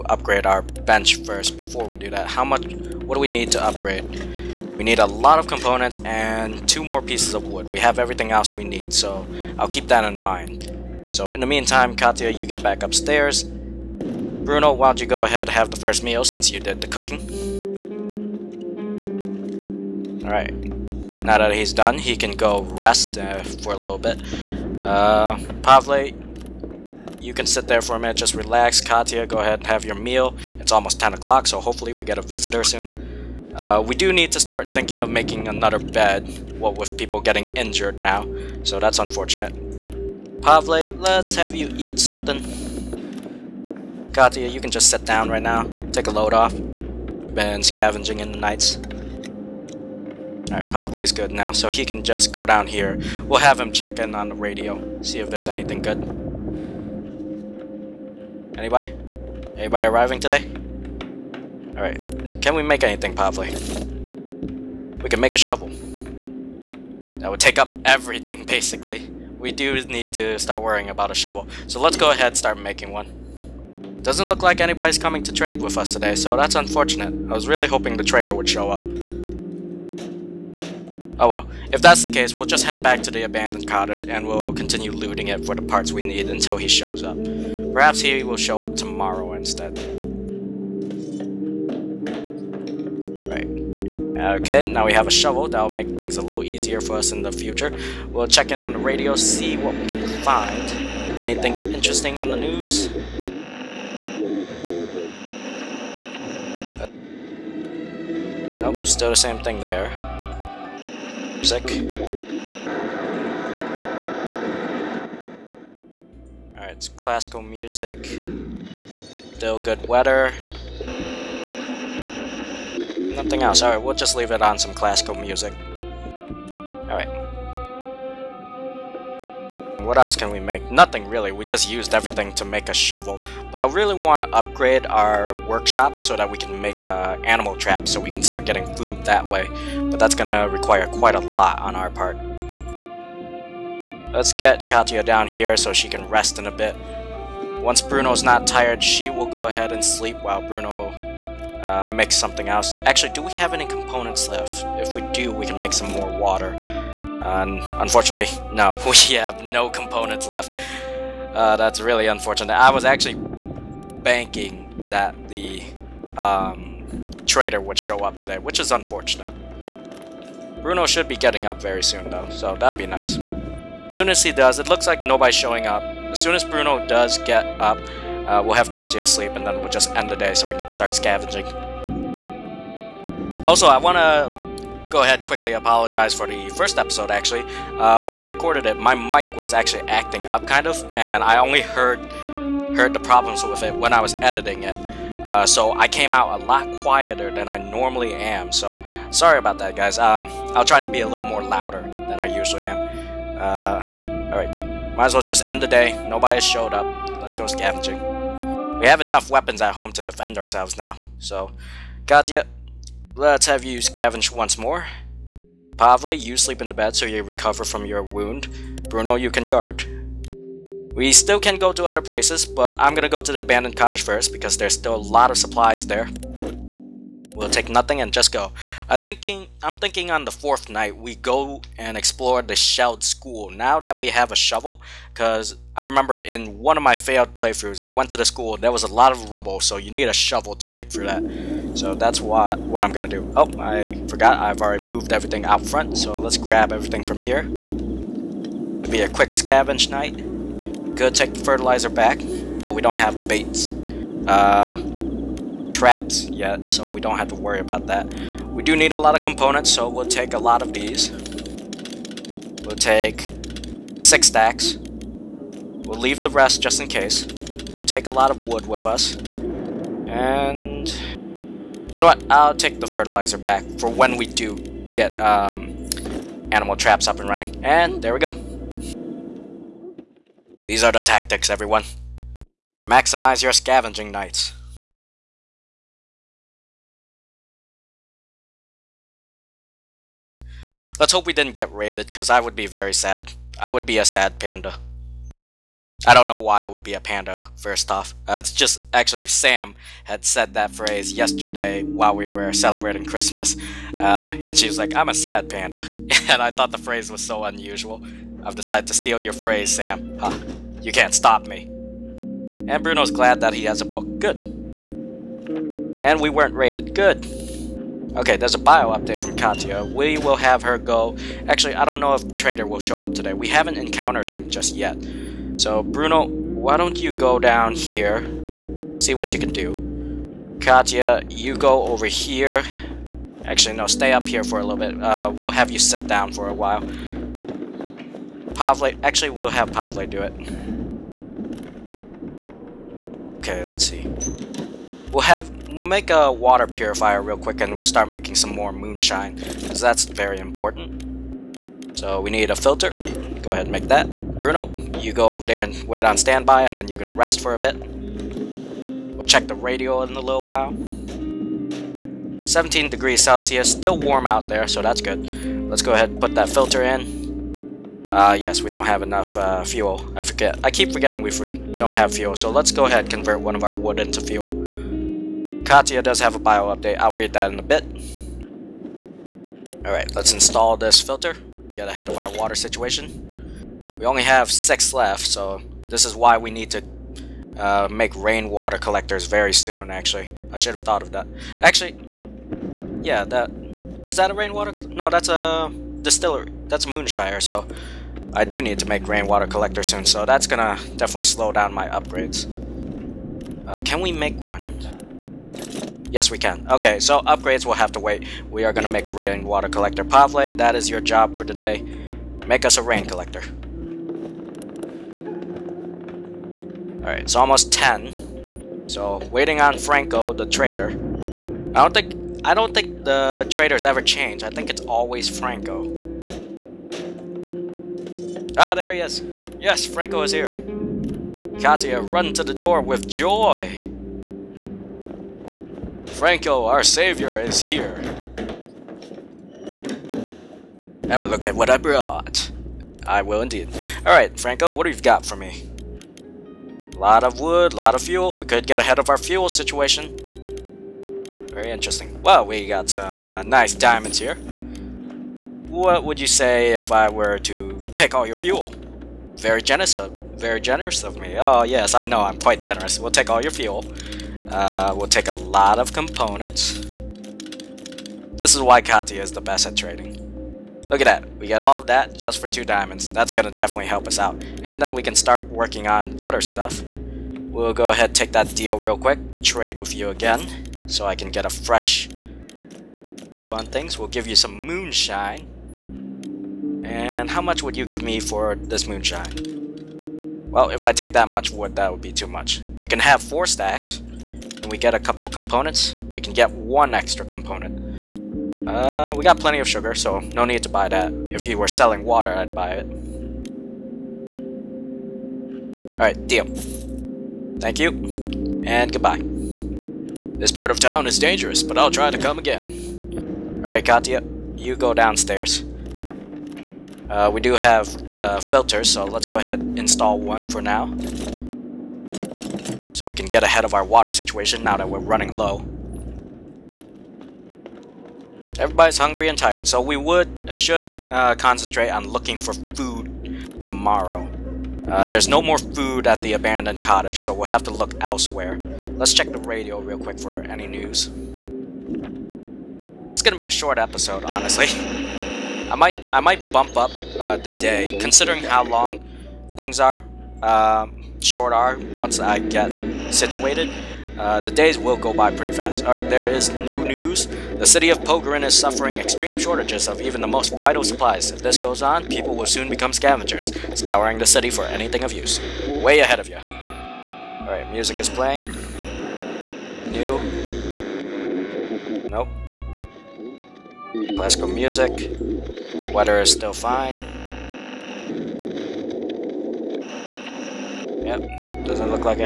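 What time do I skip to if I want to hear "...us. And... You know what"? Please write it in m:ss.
4:28.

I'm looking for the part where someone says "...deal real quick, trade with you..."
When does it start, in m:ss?
7:58.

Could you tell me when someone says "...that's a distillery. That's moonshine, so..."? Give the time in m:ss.
6:35.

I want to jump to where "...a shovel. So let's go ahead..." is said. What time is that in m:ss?
1:11.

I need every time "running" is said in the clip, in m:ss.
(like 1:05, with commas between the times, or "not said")
4:37, 8:44.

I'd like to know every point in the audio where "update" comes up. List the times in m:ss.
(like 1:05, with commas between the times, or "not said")
5:18, 6:16.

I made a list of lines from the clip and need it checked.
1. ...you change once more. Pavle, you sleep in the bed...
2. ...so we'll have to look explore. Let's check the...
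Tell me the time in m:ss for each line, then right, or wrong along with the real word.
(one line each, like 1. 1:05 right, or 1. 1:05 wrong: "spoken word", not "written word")
1. 3:33 wrong: "scavenge", not "change"
2. 8:57 wrong: "elsewhere", not "explore".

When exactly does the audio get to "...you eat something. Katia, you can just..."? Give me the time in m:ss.
0:41.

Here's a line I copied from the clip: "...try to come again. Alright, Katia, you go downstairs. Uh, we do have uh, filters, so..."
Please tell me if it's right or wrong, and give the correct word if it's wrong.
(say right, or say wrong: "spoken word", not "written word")
right.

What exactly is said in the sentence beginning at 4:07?
It'll be a quick scavenge night.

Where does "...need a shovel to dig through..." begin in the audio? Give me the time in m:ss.
3:59.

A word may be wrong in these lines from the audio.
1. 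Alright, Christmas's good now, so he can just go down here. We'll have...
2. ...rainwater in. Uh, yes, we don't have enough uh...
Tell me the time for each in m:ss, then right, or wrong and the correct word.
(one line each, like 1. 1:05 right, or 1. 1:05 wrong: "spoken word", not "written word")
1. 0:50 wrong: "Pavle", not "Christmas"
2. 6:06 wrong: "filter", not "rainwater".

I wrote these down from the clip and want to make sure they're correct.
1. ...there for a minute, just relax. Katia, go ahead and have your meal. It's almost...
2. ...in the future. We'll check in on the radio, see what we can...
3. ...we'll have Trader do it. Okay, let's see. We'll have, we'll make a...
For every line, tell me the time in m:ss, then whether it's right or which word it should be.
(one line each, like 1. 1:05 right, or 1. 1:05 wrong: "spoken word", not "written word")
1. 0:27 right
2. 1:37 right
3. 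5:39 wrong: "Pavle", not "Trader".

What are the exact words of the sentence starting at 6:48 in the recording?
We are gonna make a rainwater collector.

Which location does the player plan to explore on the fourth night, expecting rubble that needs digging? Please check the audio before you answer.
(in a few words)
Shelled school.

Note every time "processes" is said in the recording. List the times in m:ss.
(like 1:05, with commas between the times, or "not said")
not said.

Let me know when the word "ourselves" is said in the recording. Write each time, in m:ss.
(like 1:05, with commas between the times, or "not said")
3:30.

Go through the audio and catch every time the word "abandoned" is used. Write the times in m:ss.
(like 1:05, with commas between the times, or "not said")
1:23, 3:43, 8:56.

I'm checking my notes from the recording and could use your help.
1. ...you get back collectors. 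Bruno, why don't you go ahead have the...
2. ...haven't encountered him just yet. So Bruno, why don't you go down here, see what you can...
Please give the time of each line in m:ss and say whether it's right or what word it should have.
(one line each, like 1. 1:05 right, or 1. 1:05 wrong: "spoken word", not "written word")
1. 0:12 wrong: "upstairs", not "collectors"
2. 5:23 right.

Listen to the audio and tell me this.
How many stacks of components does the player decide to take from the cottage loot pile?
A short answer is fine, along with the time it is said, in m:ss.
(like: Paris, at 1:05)
6, at 4:24.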